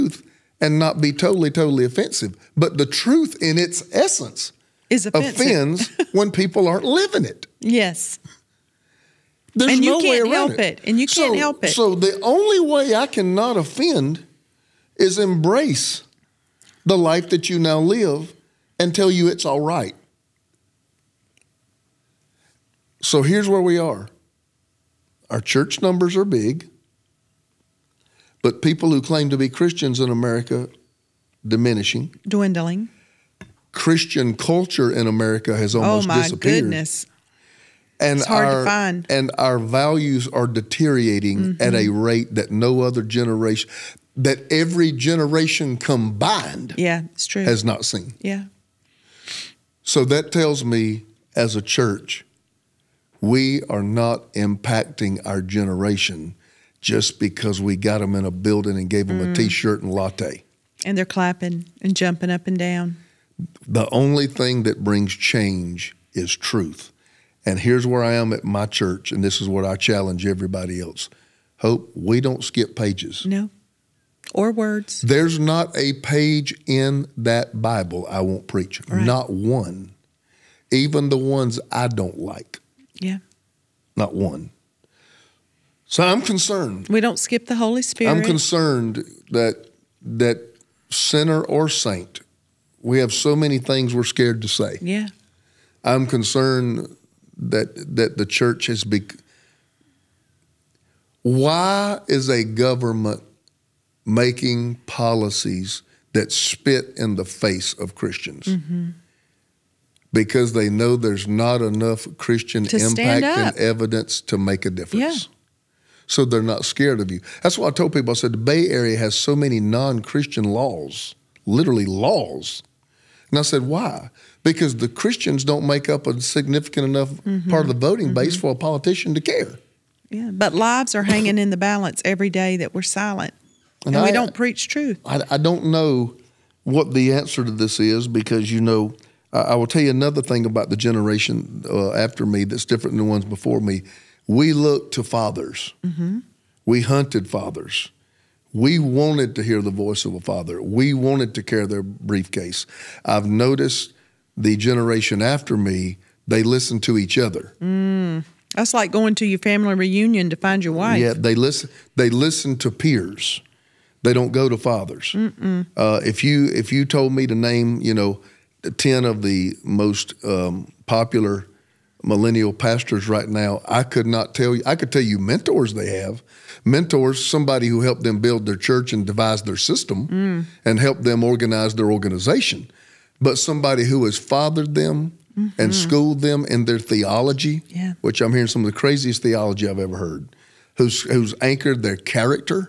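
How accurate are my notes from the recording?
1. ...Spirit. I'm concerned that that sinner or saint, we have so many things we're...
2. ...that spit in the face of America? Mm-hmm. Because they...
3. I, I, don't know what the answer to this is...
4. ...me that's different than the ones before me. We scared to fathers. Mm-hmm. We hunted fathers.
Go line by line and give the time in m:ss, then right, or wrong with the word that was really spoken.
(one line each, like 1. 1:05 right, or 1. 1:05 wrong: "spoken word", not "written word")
1. 1:27 right
2. 1:46 wrong: "Christians", not "America"
3. 2:15 right
4. 2:22 wrong: "looked", not "scared".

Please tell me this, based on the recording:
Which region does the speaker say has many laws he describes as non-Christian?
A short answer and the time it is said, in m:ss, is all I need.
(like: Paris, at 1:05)
Bay Area, at 1:58.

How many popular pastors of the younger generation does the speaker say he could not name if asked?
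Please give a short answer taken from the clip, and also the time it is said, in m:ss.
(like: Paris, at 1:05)
10, at 2:48.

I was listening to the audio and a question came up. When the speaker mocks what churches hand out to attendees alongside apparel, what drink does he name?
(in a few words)
latte.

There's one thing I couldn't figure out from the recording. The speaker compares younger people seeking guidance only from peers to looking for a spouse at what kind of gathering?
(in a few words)
family reunion.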